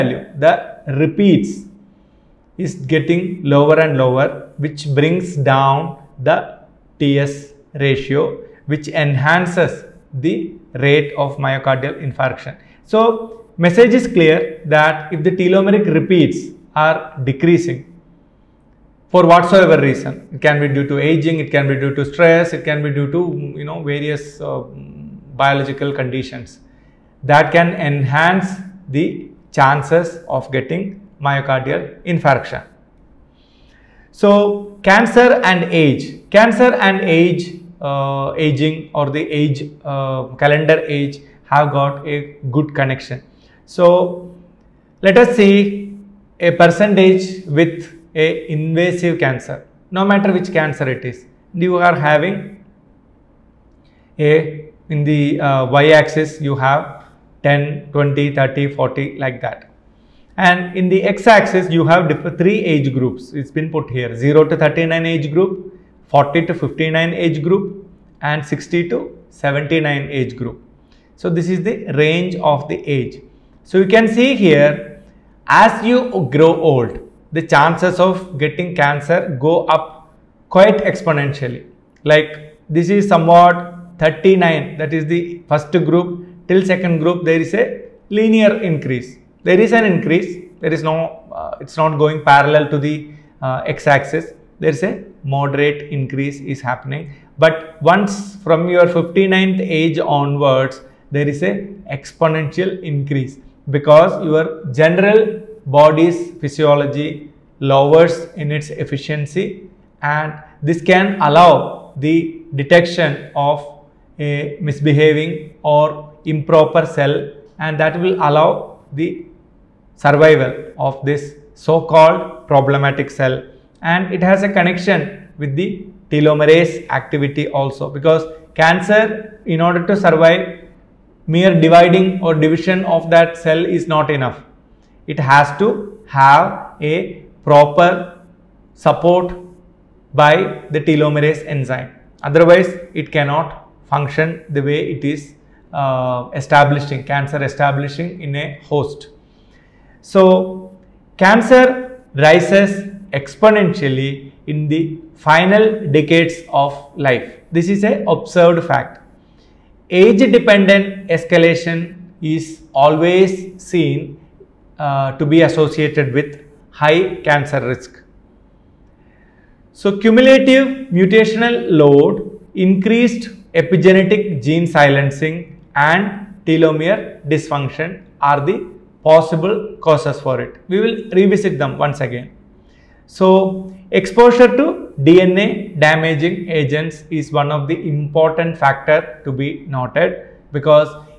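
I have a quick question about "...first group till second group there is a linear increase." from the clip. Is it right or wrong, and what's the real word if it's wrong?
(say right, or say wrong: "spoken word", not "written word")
right.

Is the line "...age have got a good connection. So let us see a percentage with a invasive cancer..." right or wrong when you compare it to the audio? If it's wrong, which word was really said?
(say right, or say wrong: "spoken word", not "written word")
right.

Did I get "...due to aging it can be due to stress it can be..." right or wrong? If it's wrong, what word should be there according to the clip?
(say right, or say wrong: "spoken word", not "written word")
right.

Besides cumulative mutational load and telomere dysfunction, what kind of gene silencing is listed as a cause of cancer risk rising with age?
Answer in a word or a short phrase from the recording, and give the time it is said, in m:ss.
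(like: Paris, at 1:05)
Epigenetic gene silencing, at 2:53.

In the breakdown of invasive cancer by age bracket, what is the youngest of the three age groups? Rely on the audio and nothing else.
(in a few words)
0 to 39.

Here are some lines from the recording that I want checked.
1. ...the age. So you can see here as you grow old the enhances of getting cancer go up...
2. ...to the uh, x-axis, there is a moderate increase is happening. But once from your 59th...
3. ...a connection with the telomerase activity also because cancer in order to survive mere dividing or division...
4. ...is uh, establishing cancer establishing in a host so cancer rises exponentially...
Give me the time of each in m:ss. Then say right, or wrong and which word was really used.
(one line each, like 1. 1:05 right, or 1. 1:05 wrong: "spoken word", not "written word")
1. 1:12 wrong: "chances", not "enhances"
2. 1:32 right
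3. 2:04 right
4. 2:25 right.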